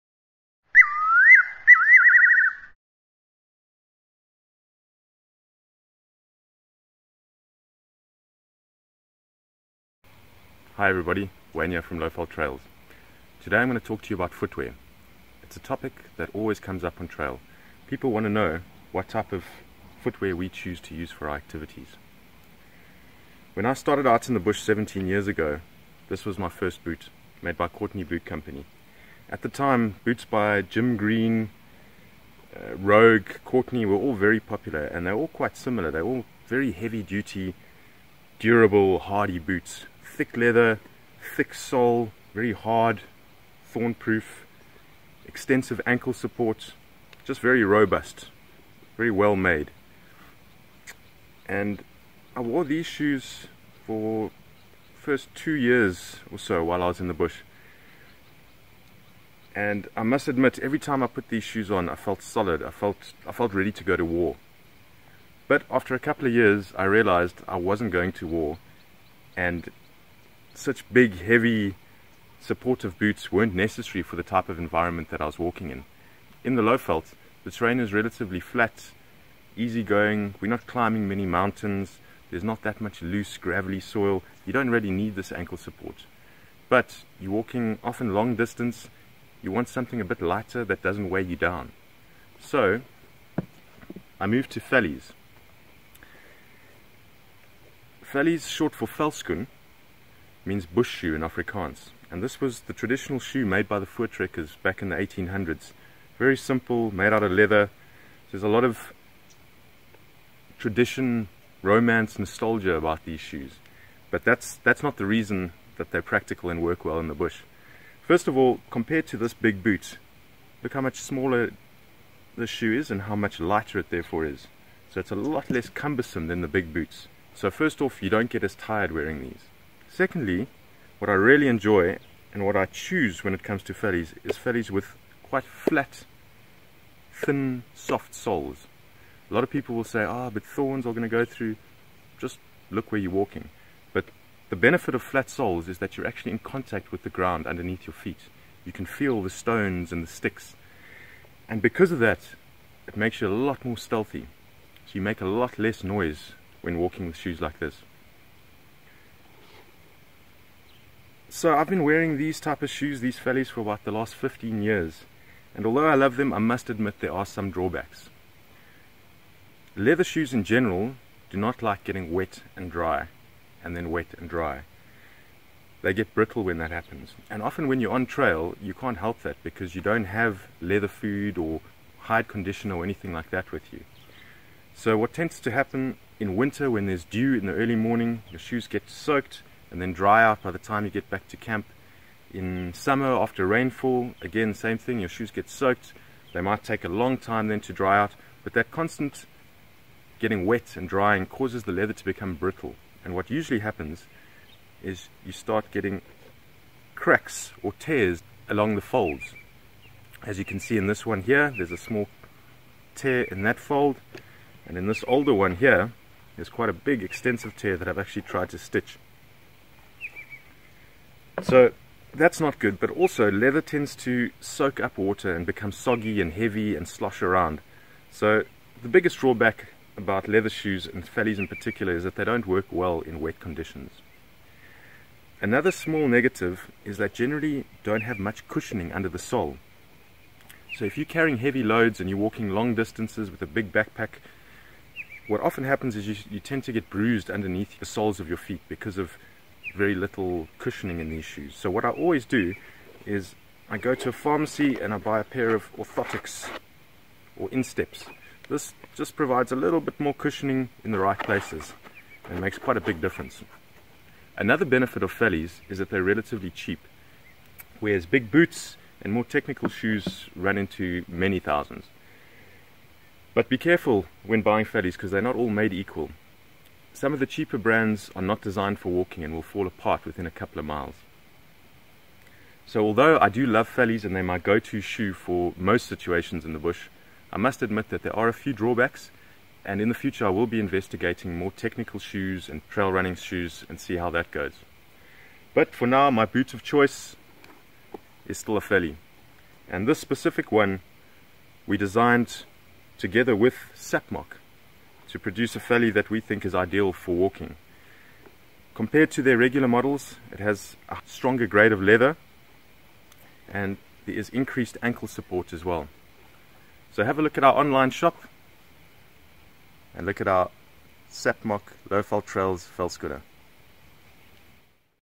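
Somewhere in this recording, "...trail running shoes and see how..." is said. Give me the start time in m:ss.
4:52.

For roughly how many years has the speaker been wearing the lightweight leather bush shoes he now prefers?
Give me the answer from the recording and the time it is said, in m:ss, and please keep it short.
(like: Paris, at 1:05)
15, at 2:44.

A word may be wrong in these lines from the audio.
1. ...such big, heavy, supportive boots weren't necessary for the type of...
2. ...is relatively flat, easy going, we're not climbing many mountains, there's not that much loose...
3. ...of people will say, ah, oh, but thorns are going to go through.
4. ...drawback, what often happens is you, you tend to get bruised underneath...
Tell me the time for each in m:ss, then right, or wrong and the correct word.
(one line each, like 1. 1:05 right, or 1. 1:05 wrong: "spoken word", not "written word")
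1. 1:10 right
2. 1:17 right
3. 2:19 right
4. 4:03 wrong: "backpack", not "drawback".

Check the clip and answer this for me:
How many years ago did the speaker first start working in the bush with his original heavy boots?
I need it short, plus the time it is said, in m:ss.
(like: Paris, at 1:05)
17, at 0:24.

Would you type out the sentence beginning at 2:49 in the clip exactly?
Leather shoes in general do not like getting wet and dry, and then wet and dry.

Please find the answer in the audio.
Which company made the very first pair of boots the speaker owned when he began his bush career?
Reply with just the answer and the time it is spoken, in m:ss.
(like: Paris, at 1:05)
Courteney Boot Company, at 0:27.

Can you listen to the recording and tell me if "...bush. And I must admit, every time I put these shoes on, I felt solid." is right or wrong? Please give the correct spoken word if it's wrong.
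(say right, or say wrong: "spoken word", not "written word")
right.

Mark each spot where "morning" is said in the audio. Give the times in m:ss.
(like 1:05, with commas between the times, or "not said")
3:07.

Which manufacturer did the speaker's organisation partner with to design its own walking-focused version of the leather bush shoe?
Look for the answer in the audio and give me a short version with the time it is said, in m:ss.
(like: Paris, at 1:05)
Sapmock, at 5:03.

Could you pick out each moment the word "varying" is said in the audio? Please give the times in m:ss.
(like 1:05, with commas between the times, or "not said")
not said.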